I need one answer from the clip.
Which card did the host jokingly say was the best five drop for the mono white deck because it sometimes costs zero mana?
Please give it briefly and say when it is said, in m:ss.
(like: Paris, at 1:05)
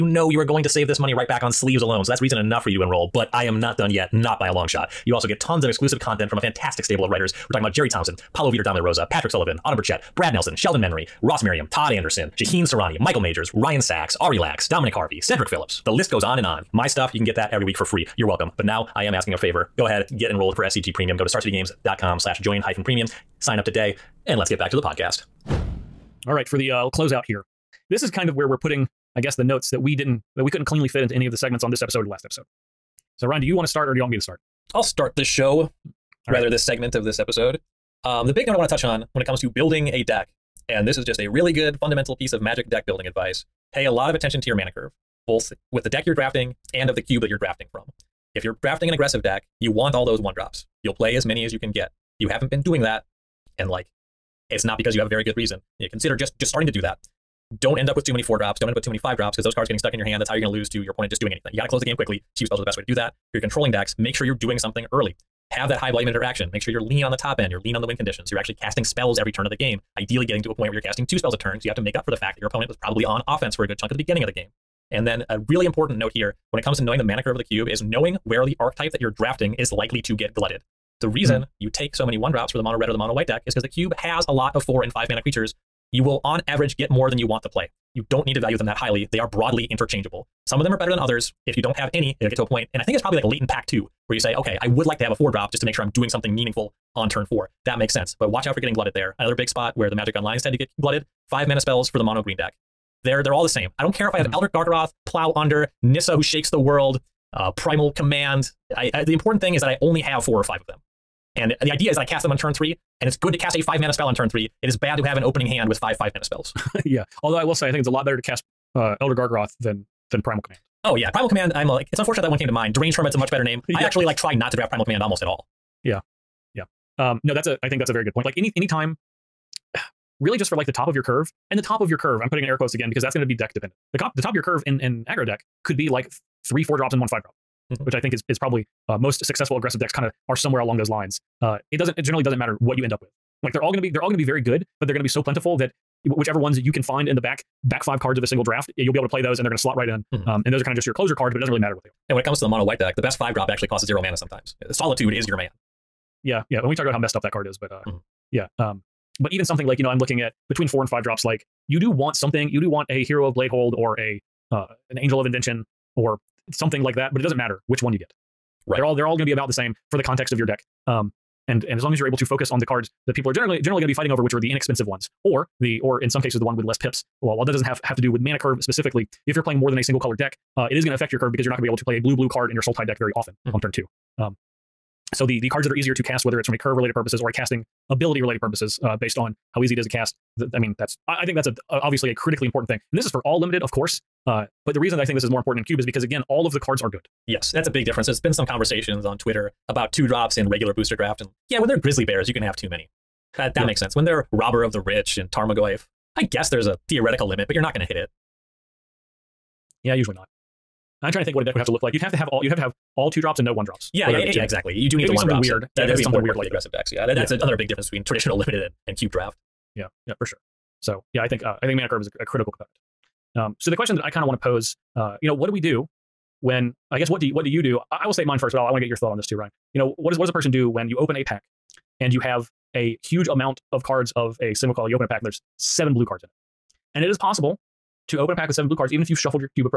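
Solitude, at 2:34.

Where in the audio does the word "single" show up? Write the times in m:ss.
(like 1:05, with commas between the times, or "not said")
2:28, 2:59, 3:54.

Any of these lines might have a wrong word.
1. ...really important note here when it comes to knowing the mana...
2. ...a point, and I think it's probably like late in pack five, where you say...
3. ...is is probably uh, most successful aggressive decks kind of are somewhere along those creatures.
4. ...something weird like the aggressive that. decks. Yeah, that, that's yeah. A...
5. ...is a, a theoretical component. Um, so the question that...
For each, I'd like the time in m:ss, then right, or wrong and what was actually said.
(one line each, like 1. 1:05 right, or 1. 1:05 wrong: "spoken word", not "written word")
1. 1:15 right
2. 1:32 wrong: "two", not "five"
3. 2:18 wrong: "lines", not "creatures"
4. 3:36 right
5. 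3:42 wrong: "critical", not "theoretical".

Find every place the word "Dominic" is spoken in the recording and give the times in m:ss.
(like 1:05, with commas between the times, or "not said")
0:14.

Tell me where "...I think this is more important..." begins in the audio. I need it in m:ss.
3:15.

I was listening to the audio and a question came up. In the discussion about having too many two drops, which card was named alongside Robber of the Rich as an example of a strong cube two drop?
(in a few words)
Tarmogoyf.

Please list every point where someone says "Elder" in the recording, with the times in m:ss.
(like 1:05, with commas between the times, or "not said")
1:44, 1:59.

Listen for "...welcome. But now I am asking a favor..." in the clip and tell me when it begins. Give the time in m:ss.
0:18.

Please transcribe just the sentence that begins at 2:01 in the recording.
I'm uh, like, it's unfortunate that one came to mind.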